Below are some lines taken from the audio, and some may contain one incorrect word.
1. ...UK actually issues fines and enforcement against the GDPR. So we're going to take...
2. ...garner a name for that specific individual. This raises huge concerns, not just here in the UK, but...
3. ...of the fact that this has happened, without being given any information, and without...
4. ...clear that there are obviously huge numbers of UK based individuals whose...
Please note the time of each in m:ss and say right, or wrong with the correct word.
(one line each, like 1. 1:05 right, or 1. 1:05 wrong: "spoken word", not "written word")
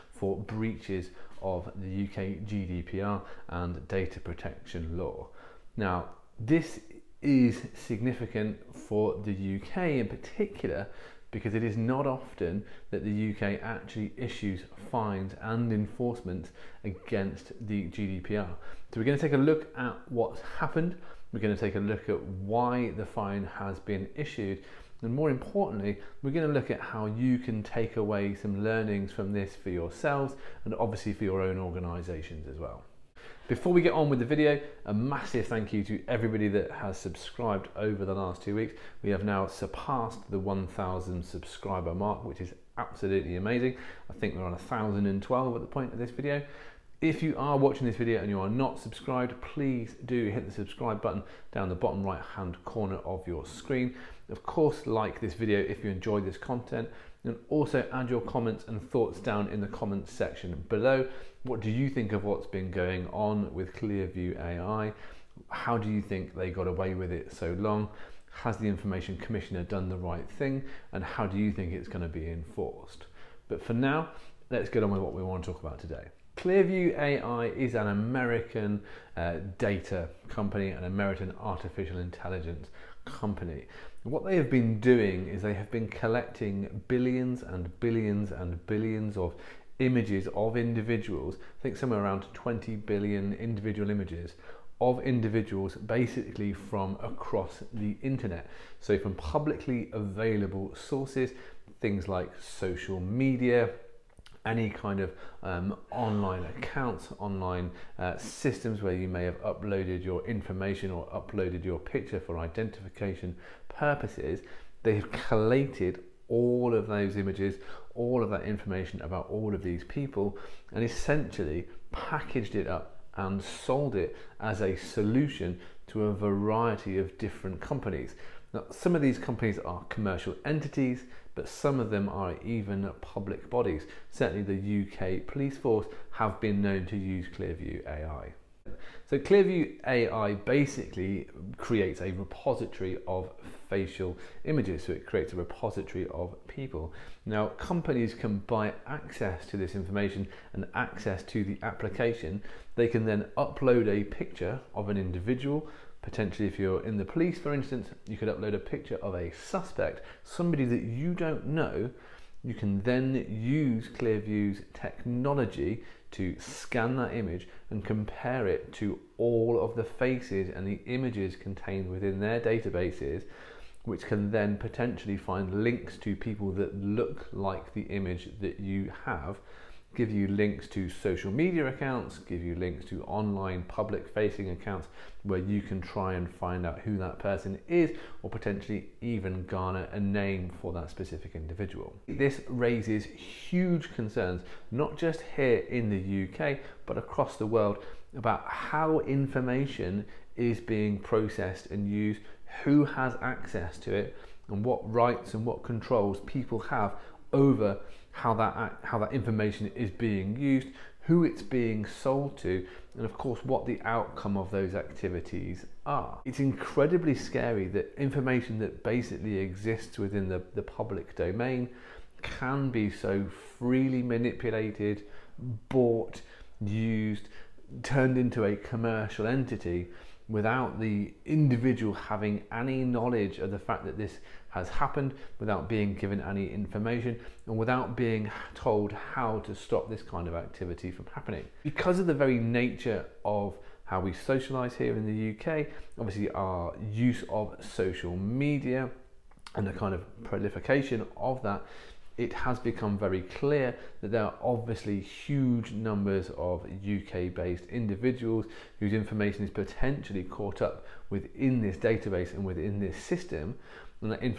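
1. 0:13 right
2. 3:09 right
3. 3:53 right
4. 4:13 right.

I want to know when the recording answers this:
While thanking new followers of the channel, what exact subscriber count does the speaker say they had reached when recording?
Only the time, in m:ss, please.
0:44.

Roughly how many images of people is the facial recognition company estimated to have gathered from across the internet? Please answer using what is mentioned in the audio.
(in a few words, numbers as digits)
20 billion.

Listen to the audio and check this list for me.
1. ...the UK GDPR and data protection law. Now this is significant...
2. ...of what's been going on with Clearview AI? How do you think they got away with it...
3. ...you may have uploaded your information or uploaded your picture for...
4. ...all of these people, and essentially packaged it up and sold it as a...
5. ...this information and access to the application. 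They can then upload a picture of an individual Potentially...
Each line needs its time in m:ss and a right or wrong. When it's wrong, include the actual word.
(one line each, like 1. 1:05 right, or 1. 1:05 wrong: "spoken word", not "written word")
1. 0:01 right
2. 1:02 right
3. 1:48 right
4. 1:59 right
5. 2:29 right.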